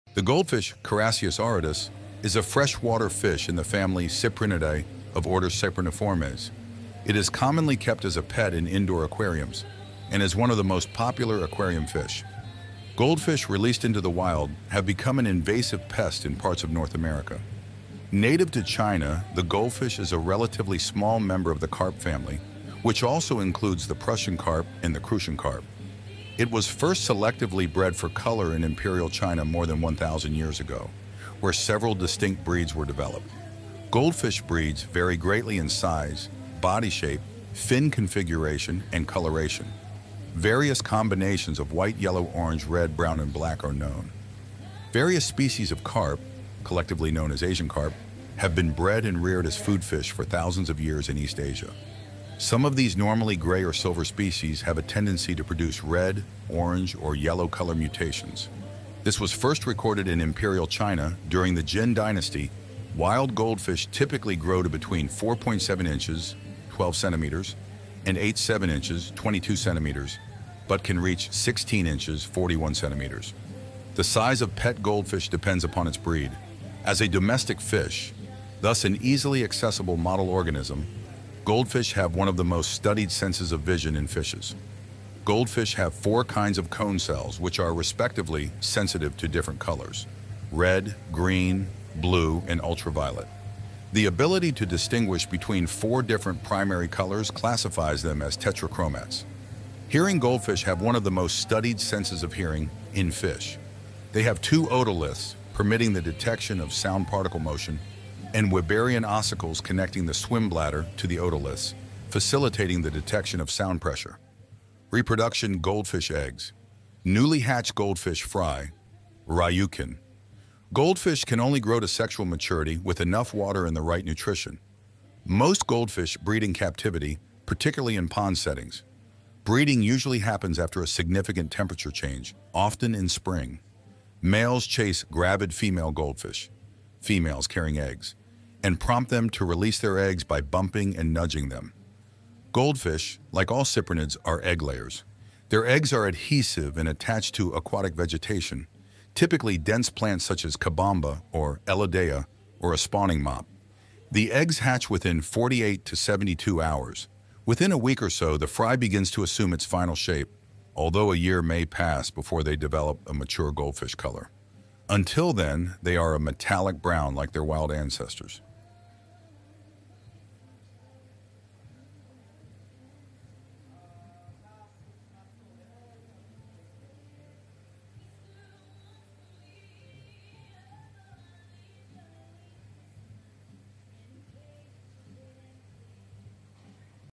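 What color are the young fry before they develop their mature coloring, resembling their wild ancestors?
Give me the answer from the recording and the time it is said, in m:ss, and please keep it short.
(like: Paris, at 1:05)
metallic brown, at 2:46.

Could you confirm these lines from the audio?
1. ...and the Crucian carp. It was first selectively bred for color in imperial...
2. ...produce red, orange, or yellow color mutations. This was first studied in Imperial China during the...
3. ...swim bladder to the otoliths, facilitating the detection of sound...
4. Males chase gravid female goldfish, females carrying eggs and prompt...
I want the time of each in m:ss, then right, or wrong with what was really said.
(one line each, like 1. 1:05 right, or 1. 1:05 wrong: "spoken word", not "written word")
1. 0:24 right
2. 0:55 wrong: "recorded", not "studied"
3. 1:50 right
4. 2:14 right.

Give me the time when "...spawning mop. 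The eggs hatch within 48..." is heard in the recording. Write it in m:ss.
2:32.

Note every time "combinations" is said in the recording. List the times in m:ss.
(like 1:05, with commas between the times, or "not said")
0:40.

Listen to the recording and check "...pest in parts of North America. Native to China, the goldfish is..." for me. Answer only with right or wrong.
right.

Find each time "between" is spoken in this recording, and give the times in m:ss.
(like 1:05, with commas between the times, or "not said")
1:04, 1:35.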